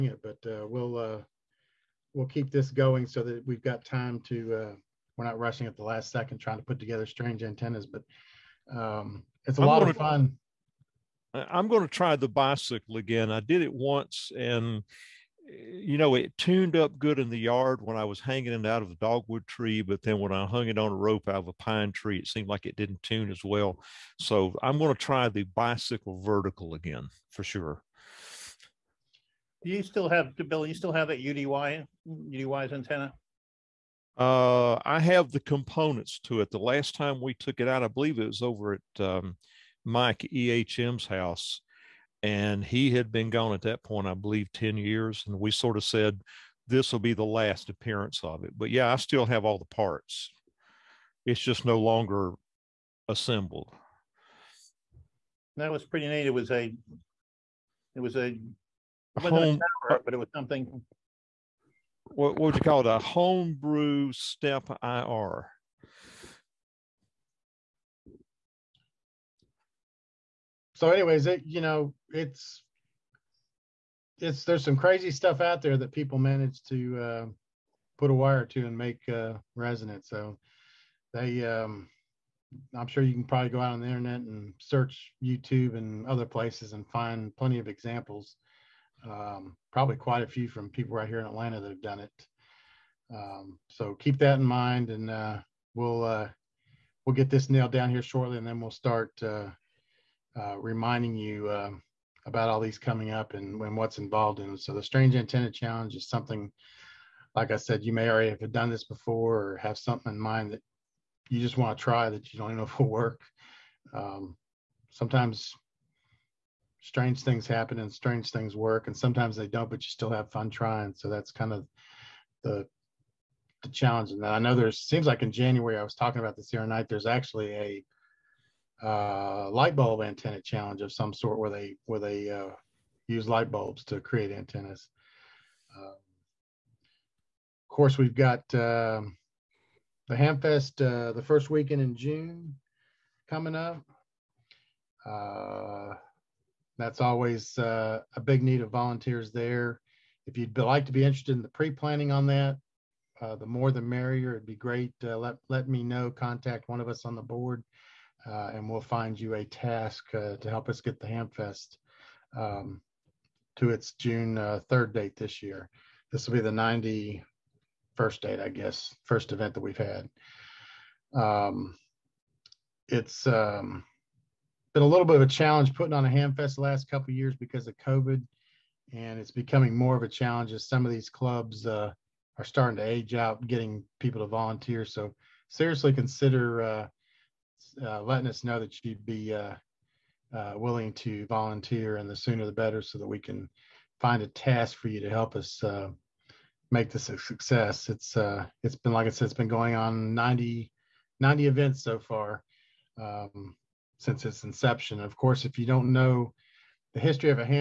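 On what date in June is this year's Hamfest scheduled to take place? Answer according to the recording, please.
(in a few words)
June 3.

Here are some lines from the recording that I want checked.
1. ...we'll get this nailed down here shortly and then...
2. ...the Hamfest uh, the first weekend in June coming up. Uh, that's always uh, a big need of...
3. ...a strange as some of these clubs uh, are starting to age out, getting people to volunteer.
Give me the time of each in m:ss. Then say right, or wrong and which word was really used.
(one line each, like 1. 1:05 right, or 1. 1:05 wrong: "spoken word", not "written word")
1. 1:37 right
2. 2:20 right
3. 3:00 wrong: "challenge", not "strange".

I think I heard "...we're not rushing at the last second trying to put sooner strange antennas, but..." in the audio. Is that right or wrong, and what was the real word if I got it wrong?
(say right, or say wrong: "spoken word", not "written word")
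wrong: "together", not "sooner".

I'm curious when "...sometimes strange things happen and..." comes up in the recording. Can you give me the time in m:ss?
1:54.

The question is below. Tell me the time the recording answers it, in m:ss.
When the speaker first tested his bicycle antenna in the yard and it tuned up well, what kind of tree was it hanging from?
0:18.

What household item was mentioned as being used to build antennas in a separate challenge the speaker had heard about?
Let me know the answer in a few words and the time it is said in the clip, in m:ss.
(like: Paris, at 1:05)
Light bulbs, at 2:13.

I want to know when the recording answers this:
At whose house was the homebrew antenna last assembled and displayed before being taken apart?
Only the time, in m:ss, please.
0:39.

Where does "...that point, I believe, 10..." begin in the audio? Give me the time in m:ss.
0:43.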